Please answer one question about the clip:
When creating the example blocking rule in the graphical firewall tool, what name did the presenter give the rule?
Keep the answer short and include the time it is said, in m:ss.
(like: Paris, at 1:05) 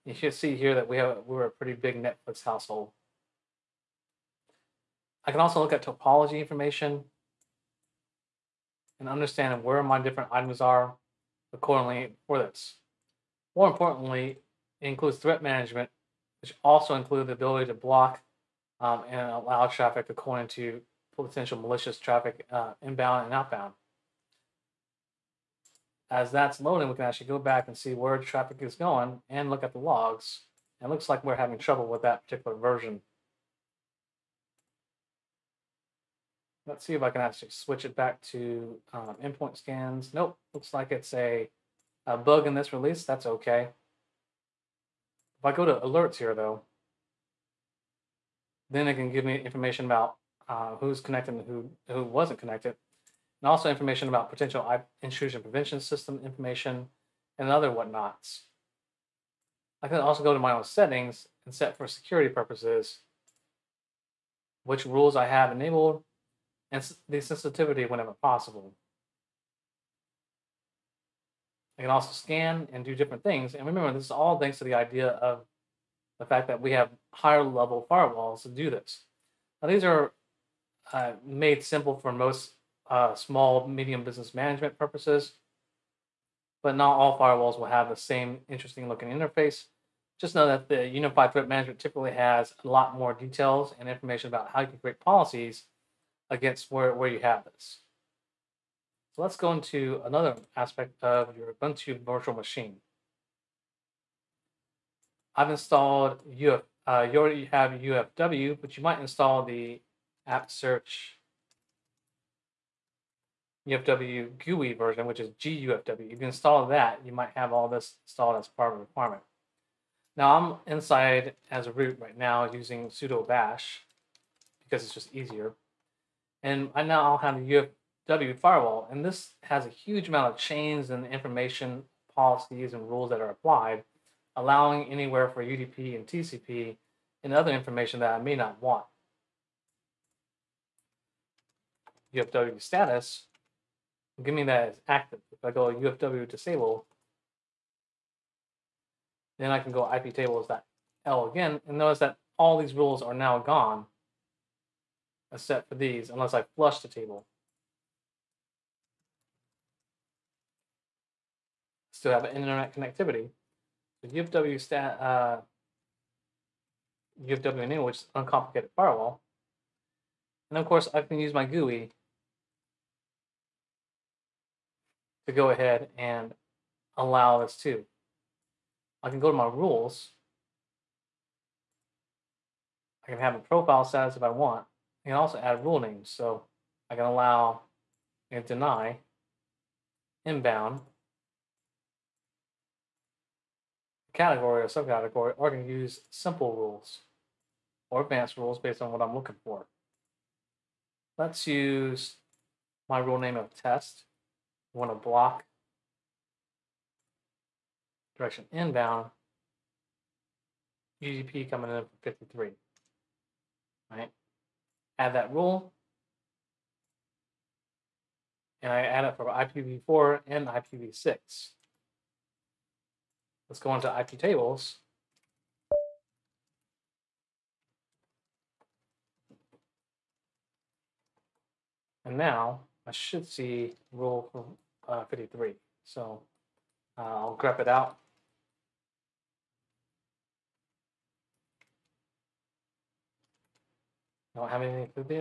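test, at 3:23.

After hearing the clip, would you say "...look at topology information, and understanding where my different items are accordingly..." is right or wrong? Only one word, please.
right.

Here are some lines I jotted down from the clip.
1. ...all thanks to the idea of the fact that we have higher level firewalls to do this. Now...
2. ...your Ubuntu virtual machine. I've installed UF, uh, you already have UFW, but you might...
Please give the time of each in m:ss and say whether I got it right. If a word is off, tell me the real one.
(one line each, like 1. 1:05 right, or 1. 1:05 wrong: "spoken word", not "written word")
1. 1:14 right
2. 1:41 right.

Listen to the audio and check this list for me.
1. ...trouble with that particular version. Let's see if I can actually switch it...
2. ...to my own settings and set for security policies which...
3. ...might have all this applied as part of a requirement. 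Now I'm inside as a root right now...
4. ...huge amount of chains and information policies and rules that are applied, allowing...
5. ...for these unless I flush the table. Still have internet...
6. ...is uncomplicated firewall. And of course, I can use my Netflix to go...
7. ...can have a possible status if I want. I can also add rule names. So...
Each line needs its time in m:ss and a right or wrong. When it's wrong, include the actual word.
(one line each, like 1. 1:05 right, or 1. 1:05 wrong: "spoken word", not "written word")
1. 0:31 right
2. 1:00 wrong: "purposes", not "policies"
3. 1:57 wrong: "installed", not "applied"
4. 2:09 right
5. 2:35 right
6. 2:47 wrong: "GUI", not "Netflix"
7. 3:03 wrong: "profile", not "possible".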